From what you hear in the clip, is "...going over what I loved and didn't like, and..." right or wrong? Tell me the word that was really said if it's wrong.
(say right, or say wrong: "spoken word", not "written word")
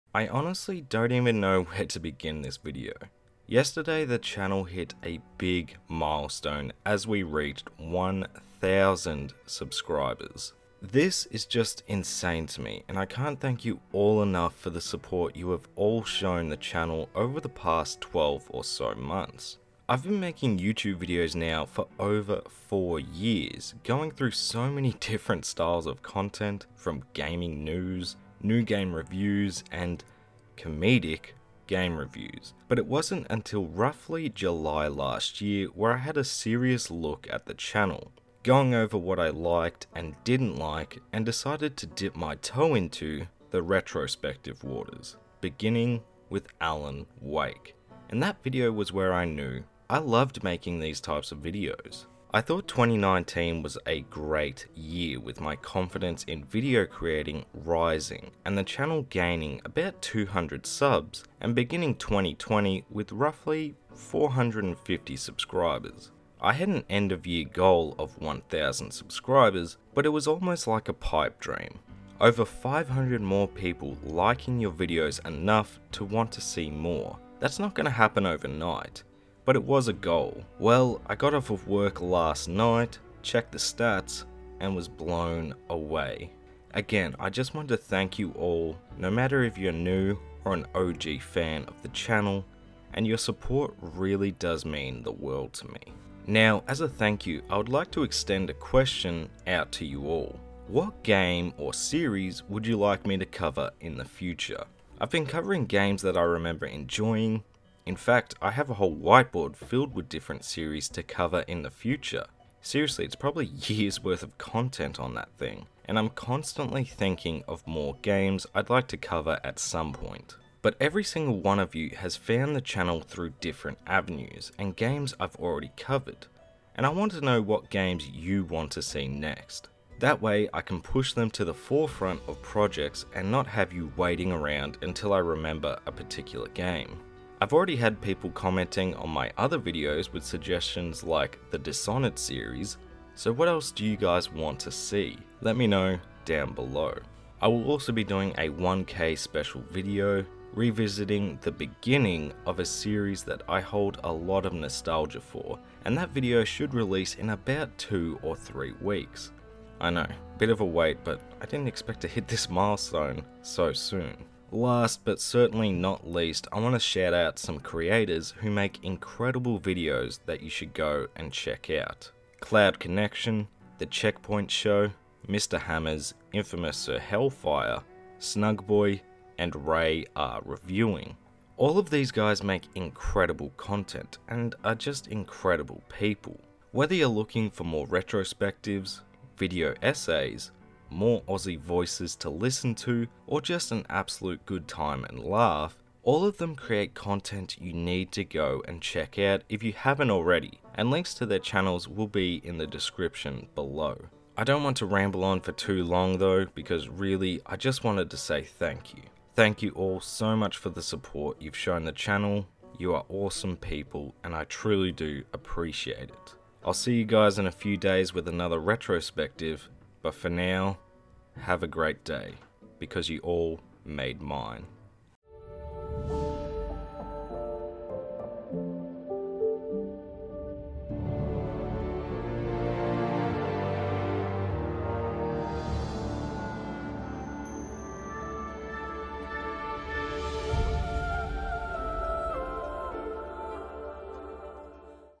wrong: "liked", not "loved".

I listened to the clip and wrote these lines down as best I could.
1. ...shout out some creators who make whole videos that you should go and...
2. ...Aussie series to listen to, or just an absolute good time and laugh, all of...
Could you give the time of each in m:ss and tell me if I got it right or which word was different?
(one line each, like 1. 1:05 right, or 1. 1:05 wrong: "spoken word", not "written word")
1. 2:46 wrong: "incredible", not "whole"
2. 3:11 wrong: "voices", not "series".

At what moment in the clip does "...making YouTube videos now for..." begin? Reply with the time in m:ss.
0:20.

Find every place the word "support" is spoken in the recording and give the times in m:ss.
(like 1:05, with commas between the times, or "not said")
0:14, 1:33, 3:30.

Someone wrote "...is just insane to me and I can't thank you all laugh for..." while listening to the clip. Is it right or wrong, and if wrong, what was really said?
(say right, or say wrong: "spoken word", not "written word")
wrong: "enough", not "laugh".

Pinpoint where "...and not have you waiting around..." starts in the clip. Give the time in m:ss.
2:13.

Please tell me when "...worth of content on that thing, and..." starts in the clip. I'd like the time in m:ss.
1:54.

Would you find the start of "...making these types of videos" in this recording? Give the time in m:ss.
0:50.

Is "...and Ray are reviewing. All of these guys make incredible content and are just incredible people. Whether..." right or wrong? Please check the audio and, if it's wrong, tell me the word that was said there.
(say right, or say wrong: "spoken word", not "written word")
right.